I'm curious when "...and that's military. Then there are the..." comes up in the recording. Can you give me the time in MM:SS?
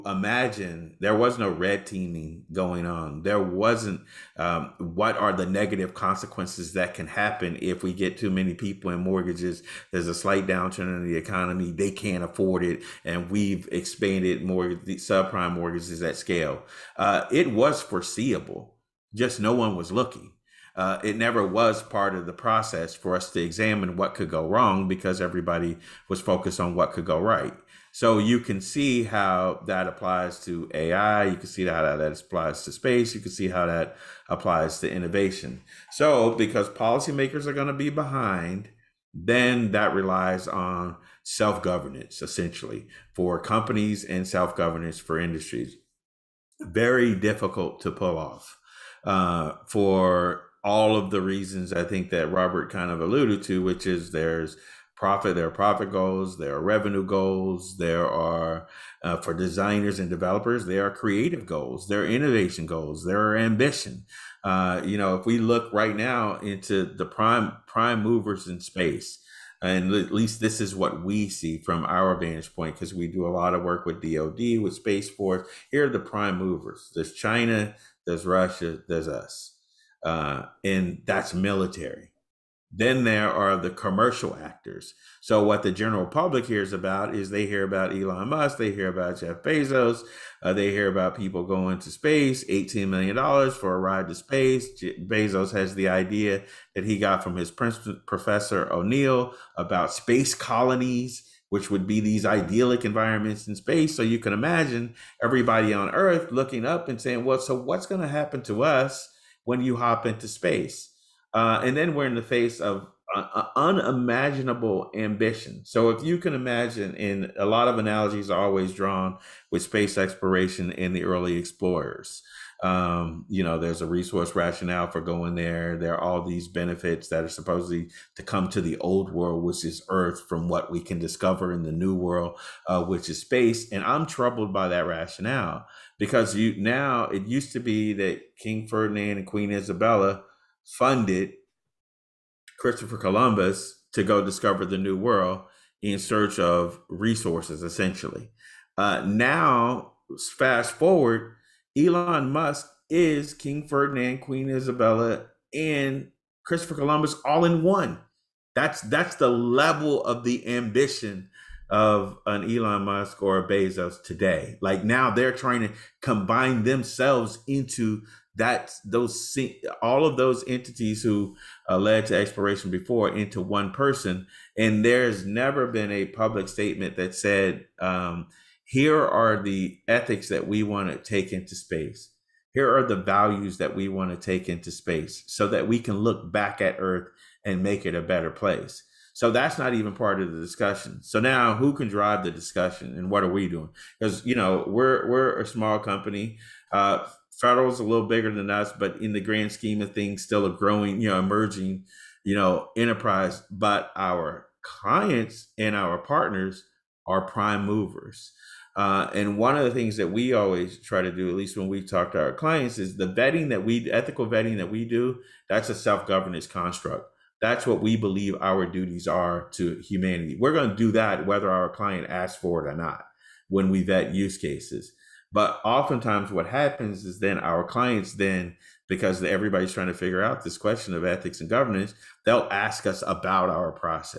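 01:20.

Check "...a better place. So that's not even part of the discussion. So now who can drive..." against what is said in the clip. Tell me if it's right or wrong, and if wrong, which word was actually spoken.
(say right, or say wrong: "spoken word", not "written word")
right.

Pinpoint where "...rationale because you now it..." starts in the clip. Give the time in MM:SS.
02:14.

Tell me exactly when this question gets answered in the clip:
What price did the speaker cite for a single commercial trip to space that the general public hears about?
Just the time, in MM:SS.
01:32.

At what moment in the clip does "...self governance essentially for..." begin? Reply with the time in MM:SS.
00:41.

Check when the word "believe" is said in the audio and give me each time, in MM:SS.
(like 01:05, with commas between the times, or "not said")
03:37.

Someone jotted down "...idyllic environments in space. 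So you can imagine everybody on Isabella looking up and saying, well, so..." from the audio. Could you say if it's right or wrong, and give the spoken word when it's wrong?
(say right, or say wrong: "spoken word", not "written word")
wrong: "Earth", not "Isabella".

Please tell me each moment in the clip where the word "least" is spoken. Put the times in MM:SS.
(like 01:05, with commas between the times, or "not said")
01:10, 03:31.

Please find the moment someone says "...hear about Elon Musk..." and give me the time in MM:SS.
01:27.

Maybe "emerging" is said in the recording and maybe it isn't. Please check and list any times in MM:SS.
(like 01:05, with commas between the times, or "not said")
03:21.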